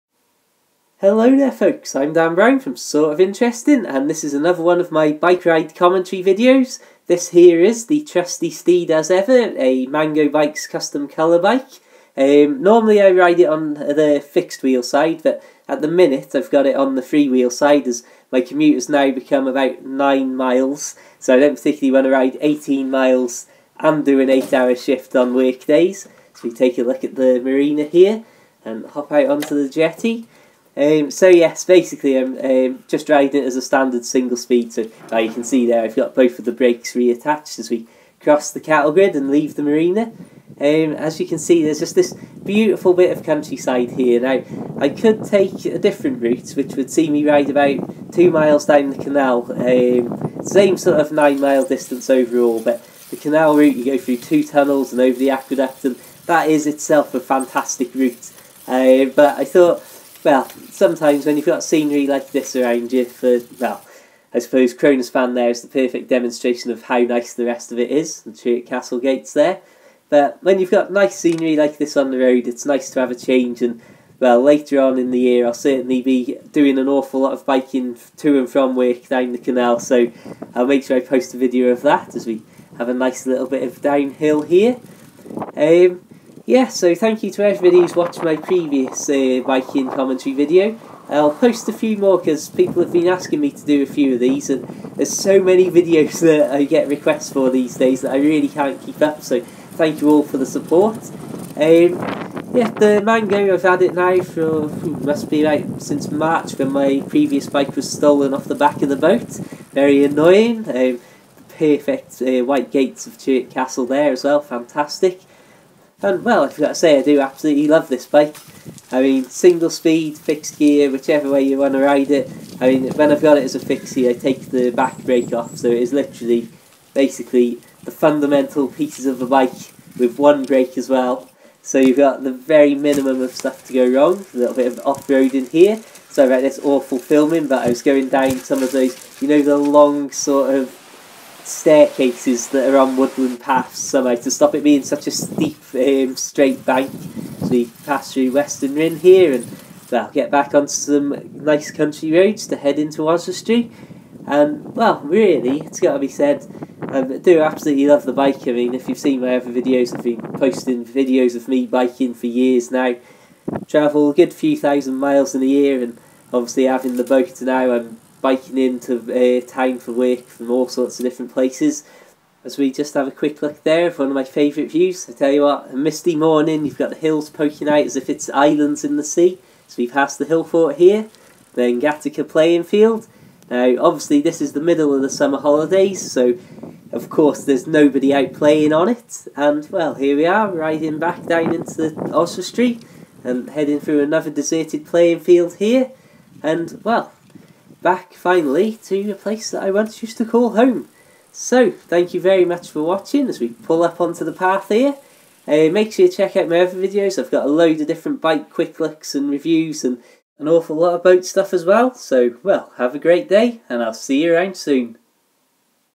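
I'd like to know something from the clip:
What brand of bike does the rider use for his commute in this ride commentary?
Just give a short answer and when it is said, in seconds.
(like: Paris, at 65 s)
Mango Bikes, at 9 s.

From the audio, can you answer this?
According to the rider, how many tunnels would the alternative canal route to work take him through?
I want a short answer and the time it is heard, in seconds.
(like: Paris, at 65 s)
2, at 54 s.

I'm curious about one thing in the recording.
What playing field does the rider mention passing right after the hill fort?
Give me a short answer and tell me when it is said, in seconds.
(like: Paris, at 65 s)
Gatacre playing field, at 181 s.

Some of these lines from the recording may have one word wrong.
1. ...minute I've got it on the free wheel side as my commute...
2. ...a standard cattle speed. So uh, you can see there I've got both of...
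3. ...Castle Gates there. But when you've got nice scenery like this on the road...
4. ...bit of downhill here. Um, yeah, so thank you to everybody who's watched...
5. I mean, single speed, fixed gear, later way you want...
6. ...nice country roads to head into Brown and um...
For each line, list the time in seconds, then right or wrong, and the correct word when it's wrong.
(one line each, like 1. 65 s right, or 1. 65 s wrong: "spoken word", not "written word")
1. 15 s right
2. 33 s wrong: "single", not "cattle"
3. 68 s right
4. 83 s right
5. 118 s wrong: "whichever", not "later"
6. 151 s wrong: "Oswestry", not "Brown".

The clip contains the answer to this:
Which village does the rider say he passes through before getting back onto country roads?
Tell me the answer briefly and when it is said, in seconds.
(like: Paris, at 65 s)
Weston Rhyn, at 148 s.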